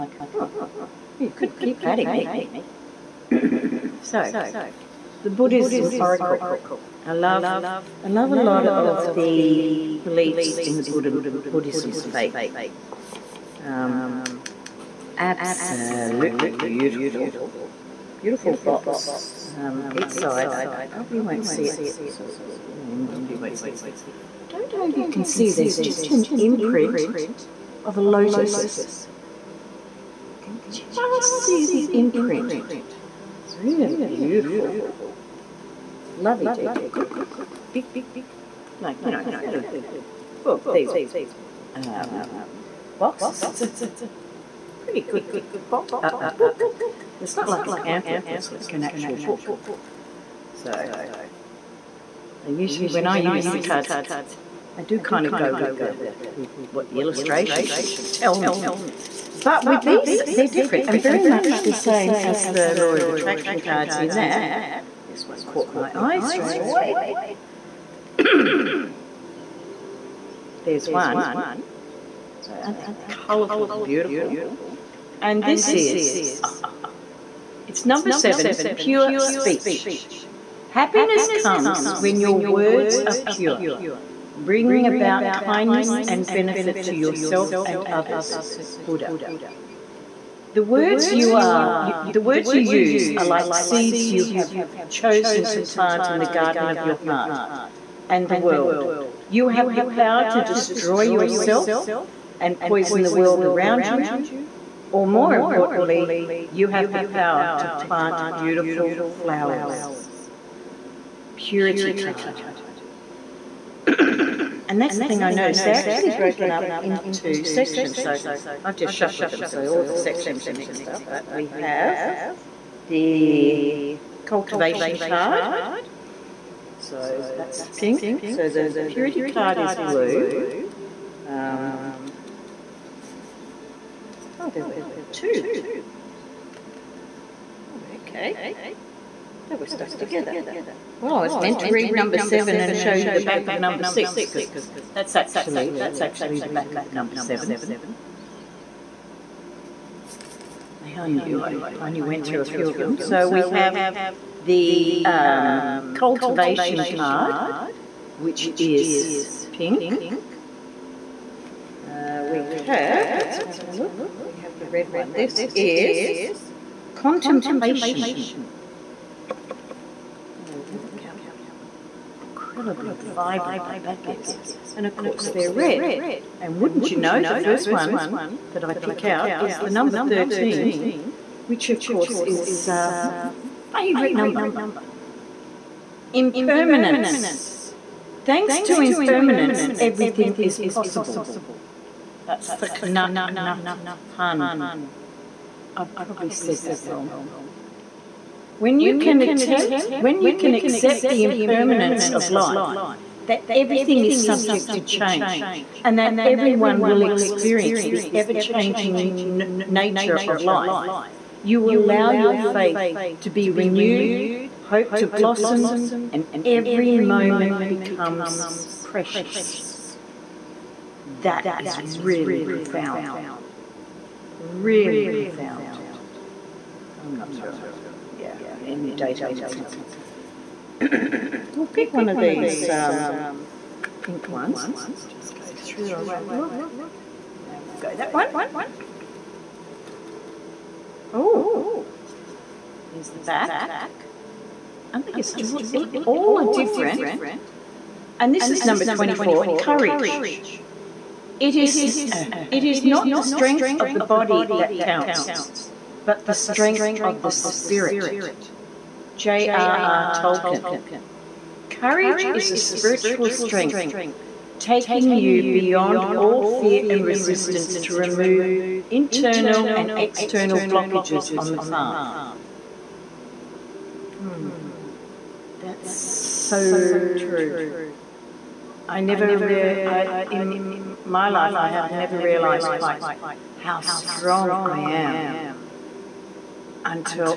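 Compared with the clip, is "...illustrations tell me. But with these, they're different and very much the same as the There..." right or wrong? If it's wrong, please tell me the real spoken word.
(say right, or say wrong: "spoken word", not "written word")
wrong: "Law", not "There".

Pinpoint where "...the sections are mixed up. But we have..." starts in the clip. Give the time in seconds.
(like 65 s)
119 s.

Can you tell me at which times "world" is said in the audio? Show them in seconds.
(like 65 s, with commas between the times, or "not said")
98 s, 103 s.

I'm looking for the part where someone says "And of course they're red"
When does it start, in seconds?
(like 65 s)
174 s.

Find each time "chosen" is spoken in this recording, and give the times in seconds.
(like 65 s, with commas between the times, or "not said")
94 s.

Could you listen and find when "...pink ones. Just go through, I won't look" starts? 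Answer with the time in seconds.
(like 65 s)
234 s.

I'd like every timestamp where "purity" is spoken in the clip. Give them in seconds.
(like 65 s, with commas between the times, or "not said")
111 s, 128 s.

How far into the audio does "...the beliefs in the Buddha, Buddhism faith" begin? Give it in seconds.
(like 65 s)
9 s.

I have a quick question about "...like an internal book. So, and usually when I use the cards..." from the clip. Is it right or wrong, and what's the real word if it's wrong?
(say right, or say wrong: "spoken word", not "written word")
wrong: "actual", not "internal".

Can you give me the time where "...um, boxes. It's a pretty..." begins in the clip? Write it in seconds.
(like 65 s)
41 s.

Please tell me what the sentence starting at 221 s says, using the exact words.
That is really profound really profound.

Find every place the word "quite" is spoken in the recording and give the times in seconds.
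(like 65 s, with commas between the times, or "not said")
282 s.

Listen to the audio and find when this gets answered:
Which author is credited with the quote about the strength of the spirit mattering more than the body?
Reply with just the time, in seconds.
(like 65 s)
259 s.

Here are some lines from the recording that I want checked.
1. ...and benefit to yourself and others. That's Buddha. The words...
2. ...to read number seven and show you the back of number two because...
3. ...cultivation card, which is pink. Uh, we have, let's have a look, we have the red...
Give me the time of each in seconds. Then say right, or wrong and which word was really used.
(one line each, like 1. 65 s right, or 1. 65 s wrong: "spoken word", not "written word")
1. 86 s right
2. 141 s wrong: "six", not "two"
3. 155 s right.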